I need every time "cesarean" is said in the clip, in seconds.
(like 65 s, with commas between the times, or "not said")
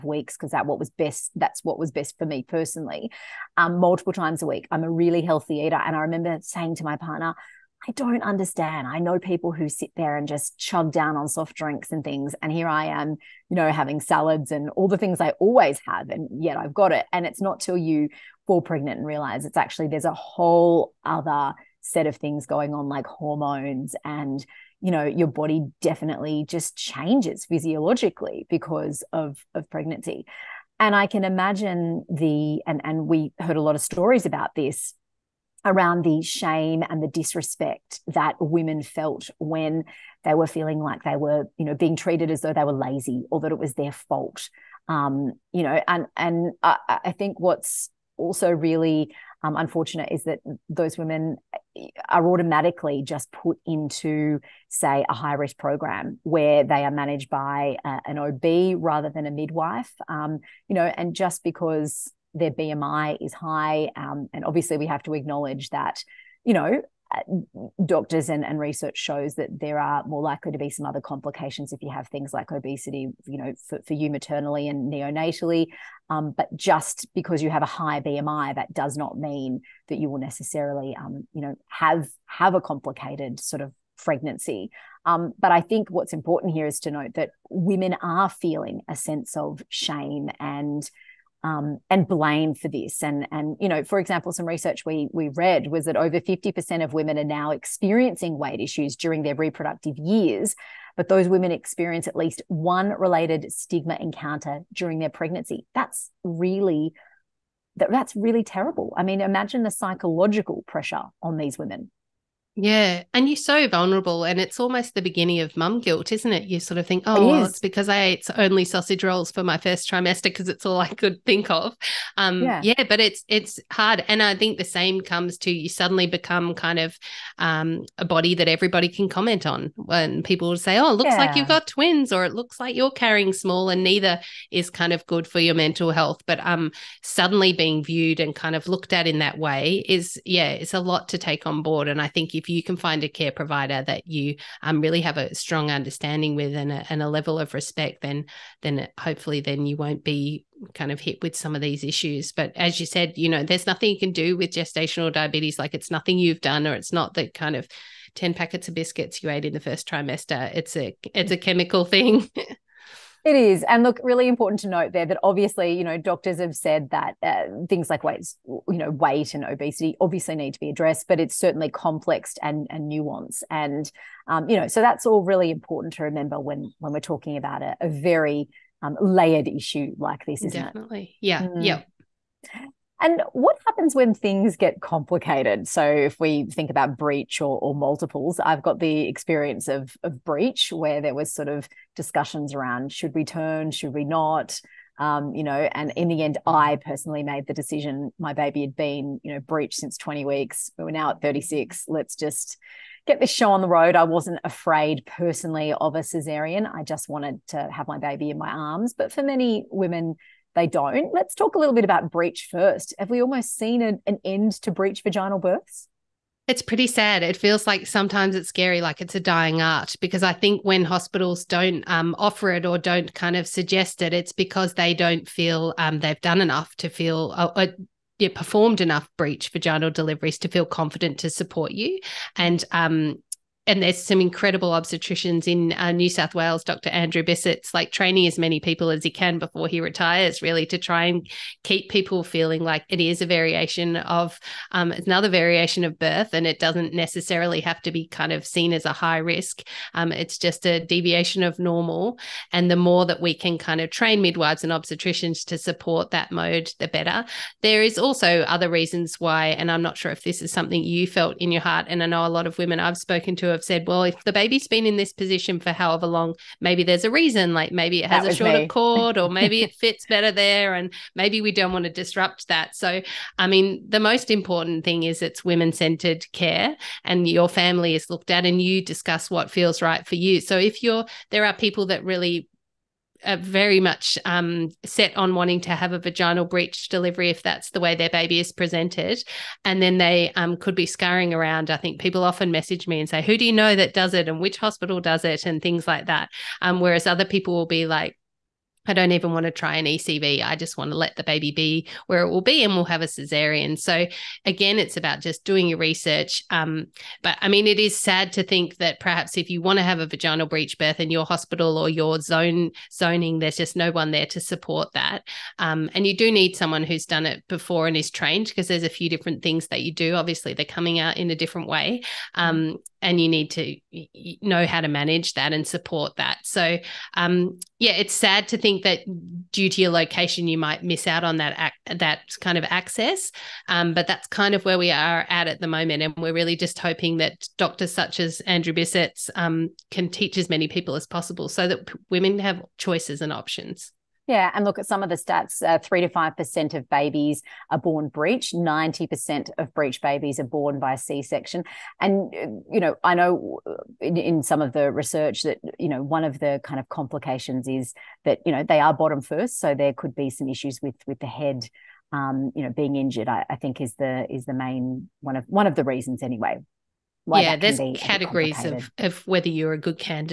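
205 s, 303 s.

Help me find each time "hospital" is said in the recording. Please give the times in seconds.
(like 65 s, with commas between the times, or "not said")
220 s, 294 s, 311 s.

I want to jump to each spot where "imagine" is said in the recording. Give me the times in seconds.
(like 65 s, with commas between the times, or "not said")
31 s, 109 s.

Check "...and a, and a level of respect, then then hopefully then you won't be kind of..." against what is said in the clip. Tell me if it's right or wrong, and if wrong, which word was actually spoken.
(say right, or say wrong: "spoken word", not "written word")
right.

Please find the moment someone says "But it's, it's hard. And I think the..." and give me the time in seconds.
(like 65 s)
122 s.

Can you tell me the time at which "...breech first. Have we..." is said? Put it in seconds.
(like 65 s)
212 s.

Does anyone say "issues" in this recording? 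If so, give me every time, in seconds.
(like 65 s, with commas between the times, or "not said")
98 s, 151 s, 179 s, 360 s.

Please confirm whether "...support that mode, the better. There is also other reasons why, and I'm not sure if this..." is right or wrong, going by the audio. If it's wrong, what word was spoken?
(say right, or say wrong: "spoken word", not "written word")
right.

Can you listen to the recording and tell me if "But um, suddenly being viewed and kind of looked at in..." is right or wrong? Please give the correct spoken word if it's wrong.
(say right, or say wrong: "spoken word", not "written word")
right.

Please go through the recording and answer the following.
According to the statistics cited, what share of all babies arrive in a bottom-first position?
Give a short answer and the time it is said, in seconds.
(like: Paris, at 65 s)
3 to 5 percent, at 345 s.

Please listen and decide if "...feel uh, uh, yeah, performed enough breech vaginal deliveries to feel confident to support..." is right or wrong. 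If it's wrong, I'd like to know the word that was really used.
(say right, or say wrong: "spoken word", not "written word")
right.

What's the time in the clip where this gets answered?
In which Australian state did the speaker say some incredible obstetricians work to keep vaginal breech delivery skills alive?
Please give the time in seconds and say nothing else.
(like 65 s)
235 s.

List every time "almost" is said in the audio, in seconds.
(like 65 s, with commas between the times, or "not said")
114 s, 213 s.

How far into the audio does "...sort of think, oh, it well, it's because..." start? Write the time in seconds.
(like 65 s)
116 s.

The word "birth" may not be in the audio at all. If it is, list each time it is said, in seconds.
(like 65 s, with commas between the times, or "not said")
215 s, 245 s, 310 s.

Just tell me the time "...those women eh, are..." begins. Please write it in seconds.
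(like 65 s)
50 s.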